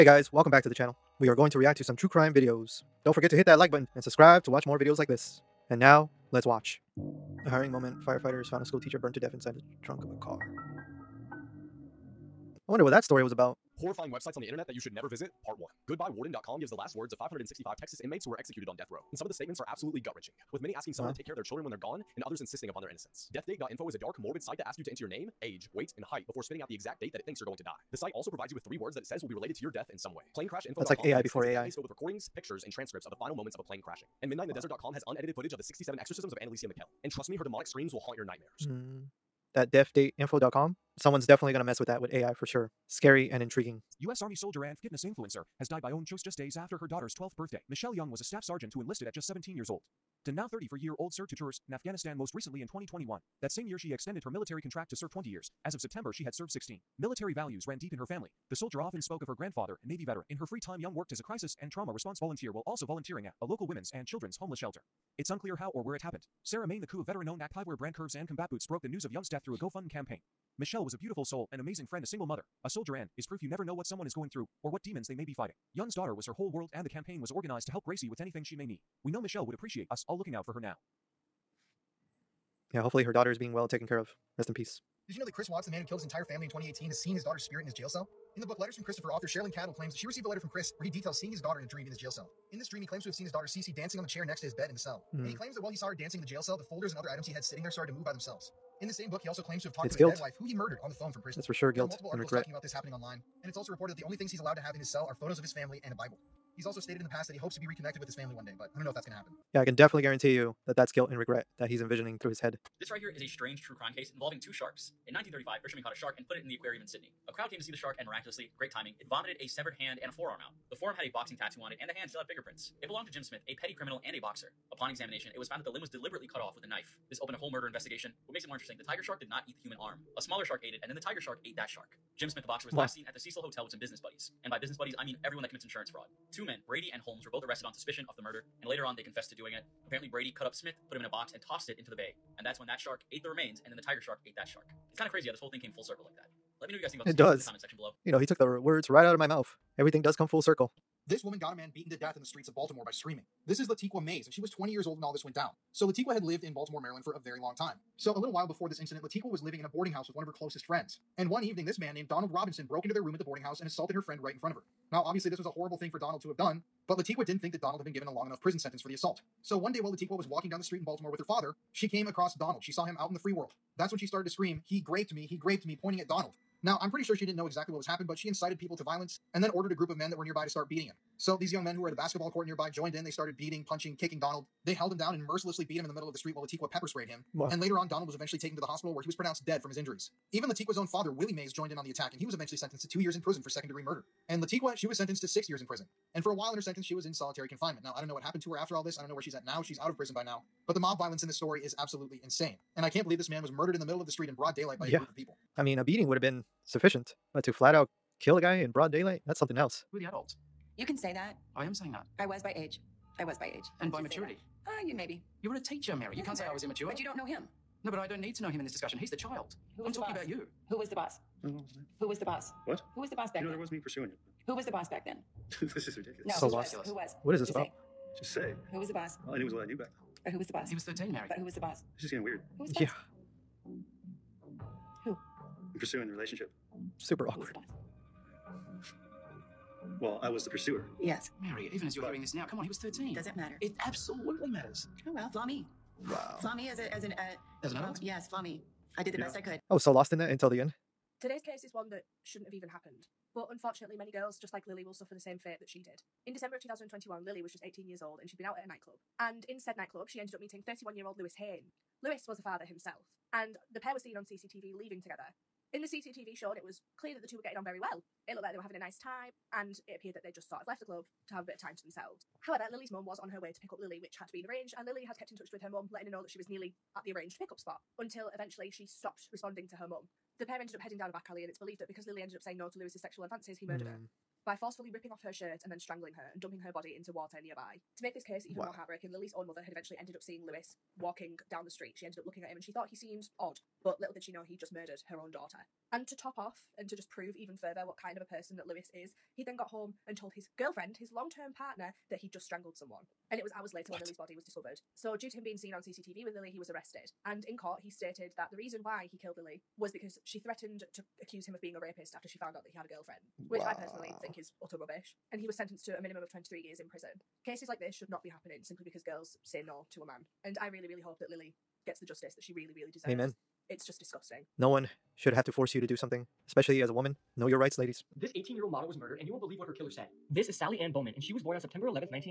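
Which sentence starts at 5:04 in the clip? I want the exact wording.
So, due to him being seen on CCTV with Lily, he was arrested.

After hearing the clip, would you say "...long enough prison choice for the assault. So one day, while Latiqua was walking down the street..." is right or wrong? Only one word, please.
wrong.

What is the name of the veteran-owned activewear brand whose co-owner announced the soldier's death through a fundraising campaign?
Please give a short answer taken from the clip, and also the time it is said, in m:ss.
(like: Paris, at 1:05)
Curves and Combat Boots, at 1:07.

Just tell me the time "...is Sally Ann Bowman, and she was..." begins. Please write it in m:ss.
5:30.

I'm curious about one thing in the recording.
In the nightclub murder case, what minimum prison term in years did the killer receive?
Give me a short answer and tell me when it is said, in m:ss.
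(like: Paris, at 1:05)
23 years, at 5:16.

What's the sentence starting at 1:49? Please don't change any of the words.
Yeah, I can definitely guarantee you that that's guilt and regret that he's envisioning through his head.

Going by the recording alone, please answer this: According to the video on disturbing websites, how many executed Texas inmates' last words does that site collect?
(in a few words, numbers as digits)
565.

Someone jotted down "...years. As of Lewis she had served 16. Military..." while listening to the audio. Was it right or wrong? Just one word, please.
wrong.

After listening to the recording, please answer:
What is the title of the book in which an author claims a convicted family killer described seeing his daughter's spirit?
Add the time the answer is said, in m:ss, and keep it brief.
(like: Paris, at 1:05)
Letters from Christopher, at 1:28.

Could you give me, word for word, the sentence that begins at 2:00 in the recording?
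The forearm had a boxing tattoo on it, and the hand still had fingerprints.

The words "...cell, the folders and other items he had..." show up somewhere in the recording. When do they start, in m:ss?
1:36.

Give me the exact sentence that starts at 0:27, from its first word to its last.
The site also provides you with three words that it says will be related to your death in some way planecrashinfo.com.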